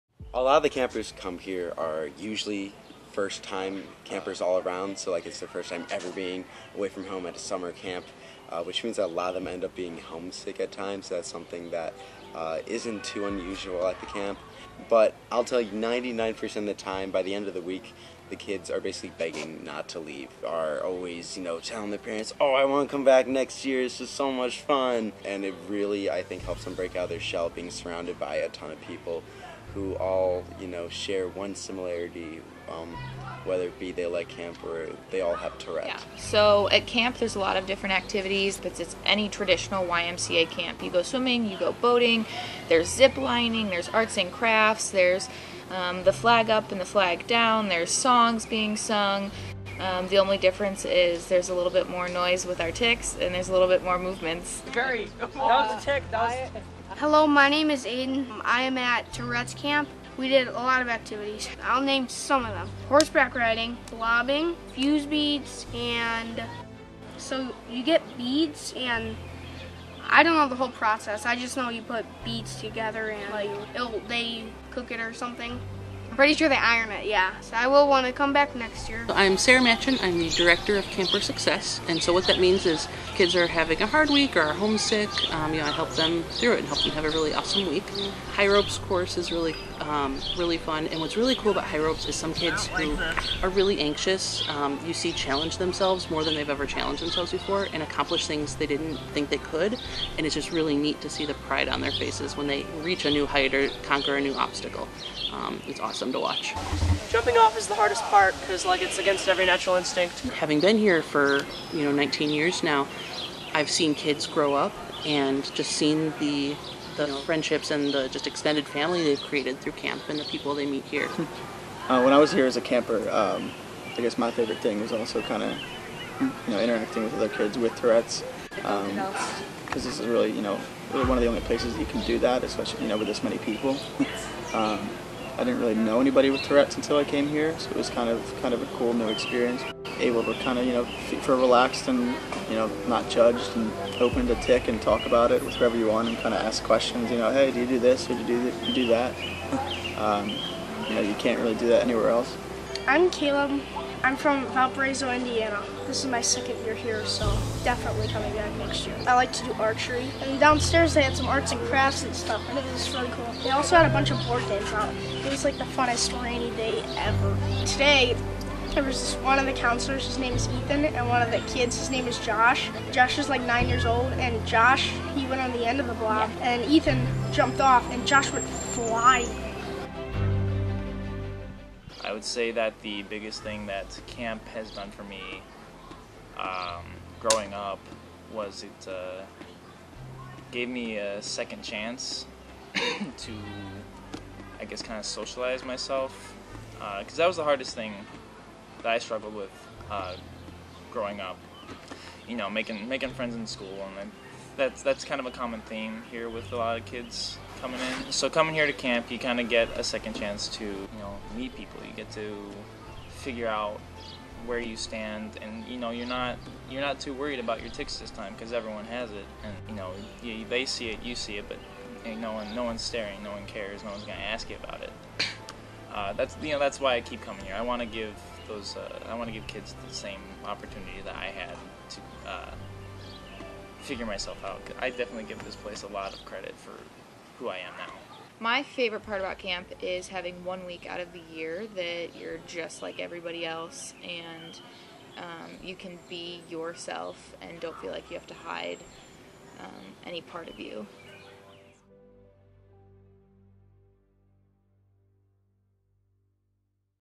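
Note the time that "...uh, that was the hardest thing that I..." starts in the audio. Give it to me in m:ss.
3:17.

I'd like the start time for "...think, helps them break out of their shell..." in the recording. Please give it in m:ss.
0:26.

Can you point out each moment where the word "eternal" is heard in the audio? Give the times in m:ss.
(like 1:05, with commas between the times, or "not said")
not said.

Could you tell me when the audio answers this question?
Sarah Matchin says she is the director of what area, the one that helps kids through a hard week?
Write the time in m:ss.
1:20.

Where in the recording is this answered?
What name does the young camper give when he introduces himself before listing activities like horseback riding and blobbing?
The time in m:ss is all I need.
0:57.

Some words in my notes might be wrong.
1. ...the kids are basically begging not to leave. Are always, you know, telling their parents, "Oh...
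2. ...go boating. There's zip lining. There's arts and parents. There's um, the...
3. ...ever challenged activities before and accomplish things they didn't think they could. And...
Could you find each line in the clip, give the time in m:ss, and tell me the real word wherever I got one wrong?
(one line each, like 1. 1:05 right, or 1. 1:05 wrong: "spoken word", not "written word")
1. 0:18 right
2. 0:41 wrong: "crafts", not "parents"
3. 1:36 wrong: "themselves", not "activities".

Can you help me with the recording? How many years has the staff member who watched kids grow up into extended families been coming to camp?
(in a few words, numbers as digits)
19.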